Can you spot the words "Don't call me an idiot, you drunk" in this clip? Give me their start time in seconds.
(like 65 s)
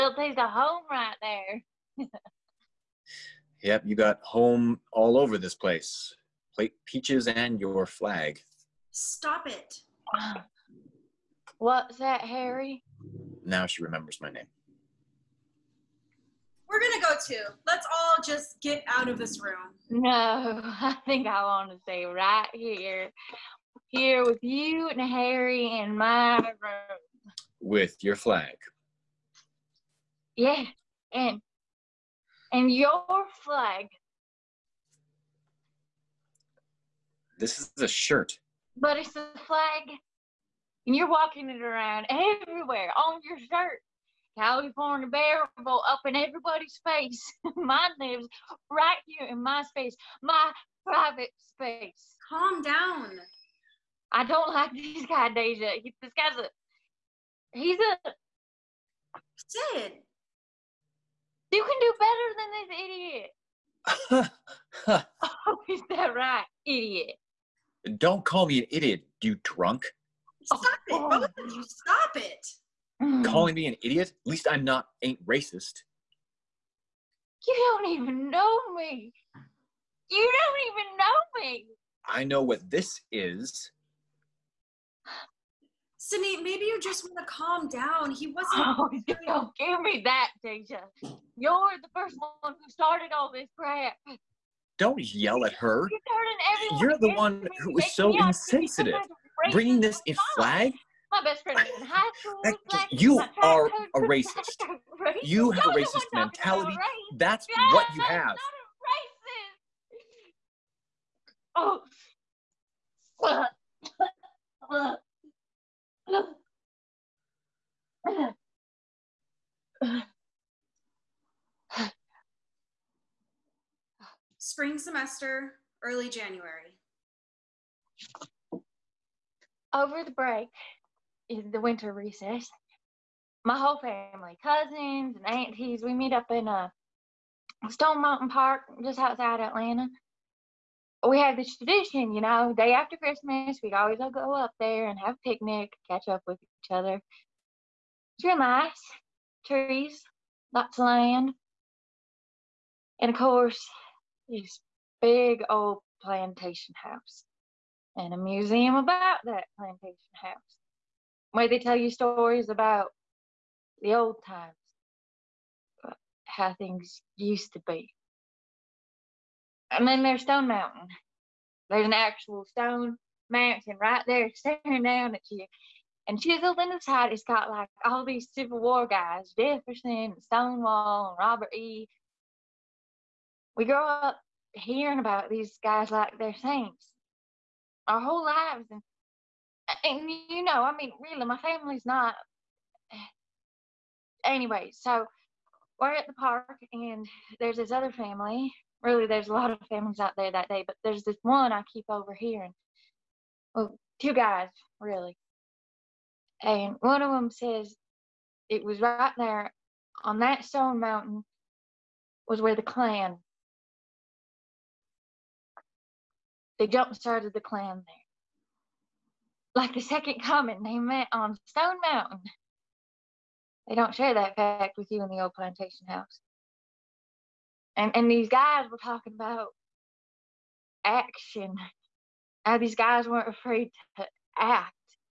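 67 s.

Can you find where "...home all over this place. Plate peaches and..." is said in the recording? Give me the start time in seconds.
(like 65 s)
4 s.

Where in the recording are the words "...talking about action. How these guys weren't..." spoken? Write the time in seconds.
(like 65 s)
228 s.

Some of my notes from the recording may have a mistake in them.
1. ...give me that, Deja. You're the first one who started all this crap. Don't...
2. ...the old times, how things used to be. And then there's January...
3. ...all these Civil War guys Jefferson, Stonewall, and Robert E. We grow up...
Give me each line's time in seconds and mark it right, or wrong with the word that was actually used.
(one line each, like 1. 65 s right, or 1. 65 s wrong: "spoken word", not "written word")
1. 89 s right
2. 163 s wrong: "Stone", not "January"
3. 177 s right.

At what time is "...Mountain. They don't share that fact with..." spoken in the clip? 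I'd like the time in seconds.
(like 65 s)
221 s.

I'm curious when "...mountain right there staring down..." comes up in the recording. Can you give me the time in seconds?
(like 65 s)
173 s.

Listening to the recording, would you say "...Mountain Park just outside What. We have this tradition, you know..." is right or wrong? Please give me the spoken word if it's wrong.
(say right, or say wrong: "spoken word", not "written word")
wrong: "Atlanta", not "What".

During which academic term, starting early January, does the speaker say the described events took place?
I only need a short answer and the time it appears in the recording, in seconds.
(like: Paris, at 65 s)
Spring semester, at 124 s.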